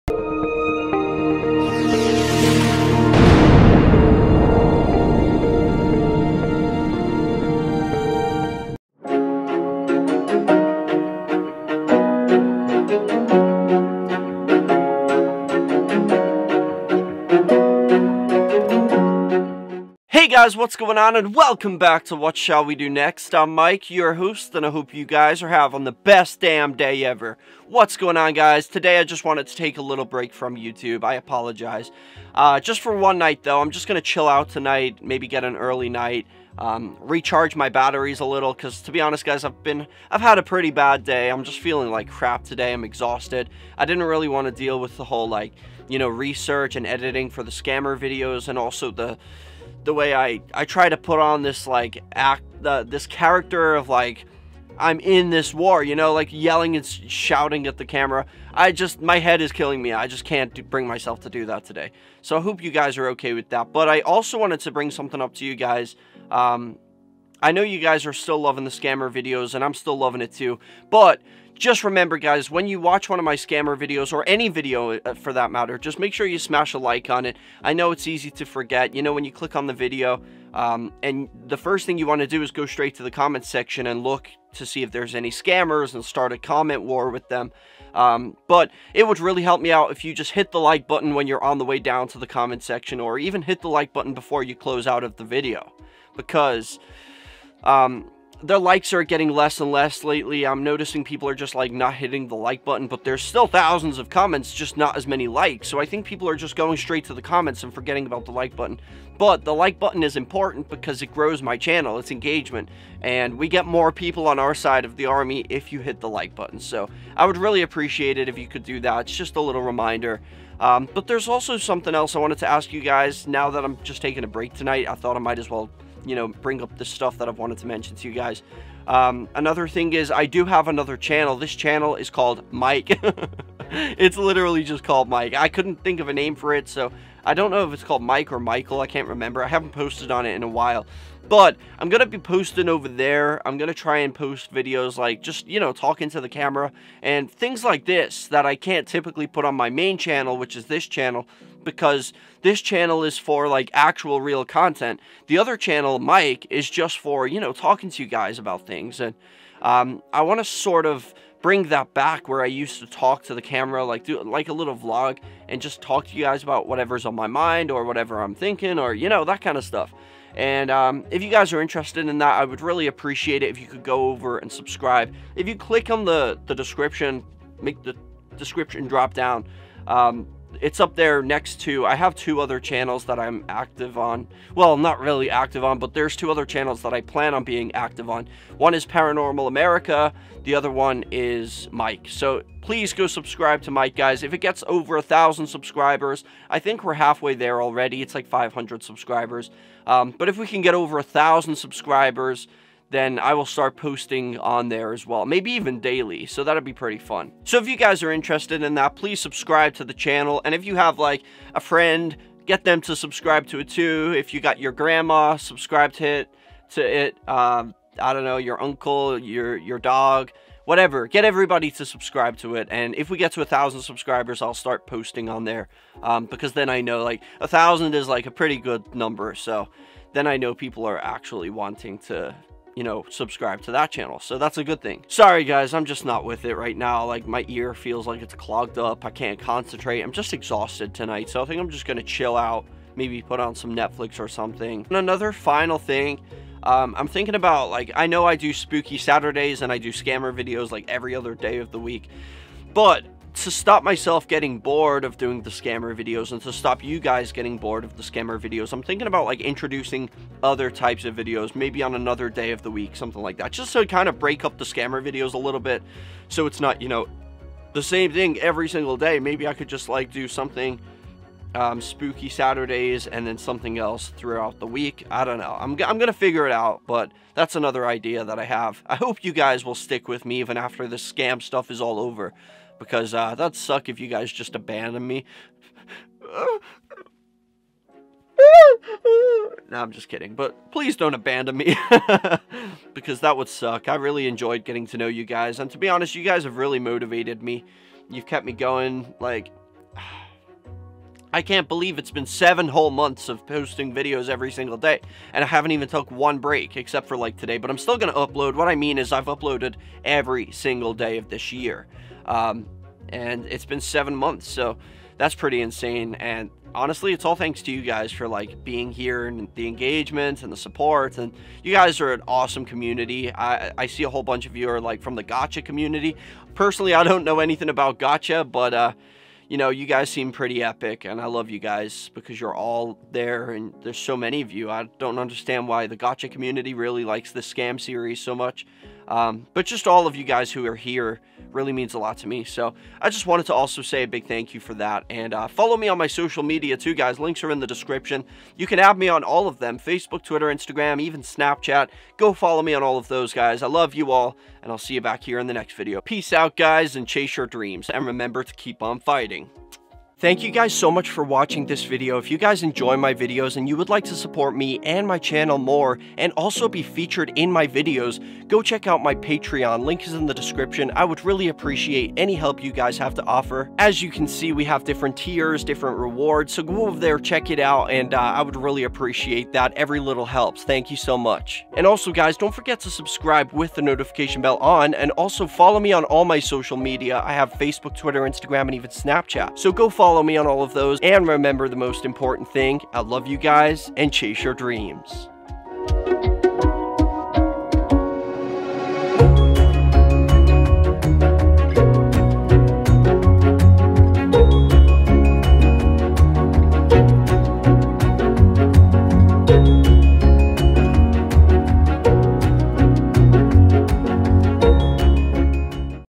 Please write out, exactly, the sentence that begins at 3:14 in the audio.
If it gets over a thousand subscribers, I think we're halfway there already.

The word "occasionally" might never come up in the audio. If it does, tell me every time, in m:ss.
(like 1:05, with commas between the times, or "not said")
not said.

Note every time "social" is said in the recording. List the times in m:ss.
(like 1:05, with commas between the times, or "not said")
5:46, 6:26.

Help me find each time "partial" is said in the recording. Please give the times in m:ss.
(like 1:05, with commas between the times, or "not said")
not said.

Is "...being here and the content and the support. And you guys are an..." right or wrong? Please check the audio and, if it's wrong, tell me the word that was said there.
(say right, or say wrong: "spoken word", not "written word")
wrong: "engagement", not "content".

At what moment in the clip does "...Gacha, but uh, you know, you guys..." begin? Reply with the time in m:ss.
5:27.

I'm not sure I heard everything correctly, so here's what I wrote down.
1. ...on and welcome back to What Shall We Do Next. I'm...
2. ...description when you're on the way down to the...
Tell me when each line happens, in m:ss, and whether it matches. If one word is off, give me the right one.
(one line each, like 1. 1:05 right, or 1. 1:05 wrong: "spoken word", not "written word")
1. 0:20 right
2. 1:30 wrong: "button", not "description".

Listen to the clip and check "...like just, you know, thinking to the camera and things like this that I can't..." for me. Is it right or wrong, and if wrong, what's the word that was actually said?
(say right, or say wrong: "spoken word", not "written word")
wrong: "talking", not "thinking".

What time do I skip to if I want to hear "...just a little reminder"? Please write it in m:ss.
1:59.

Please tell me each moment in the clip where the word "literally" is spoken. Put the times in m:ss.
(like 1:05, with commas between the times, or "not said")
2:14.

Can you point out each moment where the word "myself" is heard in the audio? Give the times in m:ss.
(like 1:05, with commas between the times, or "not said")
1:00, 4:13.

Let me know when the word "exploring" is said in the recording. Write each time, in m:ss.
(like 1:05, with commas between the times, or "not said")
not said.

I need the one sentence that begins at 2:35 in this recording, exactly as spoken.
The other channel, Mike, is just for, you know, talking to you guys about things.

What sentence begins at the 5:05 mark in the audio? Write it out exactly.
And I haven't even took one break except for like today.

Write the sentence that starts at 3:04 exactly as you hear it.
Well, not really active on, but there's two other channels that I plan on being active on.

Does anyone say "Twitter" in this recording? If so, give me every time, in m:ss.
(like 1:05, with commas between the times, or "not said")
5:50, 6:27.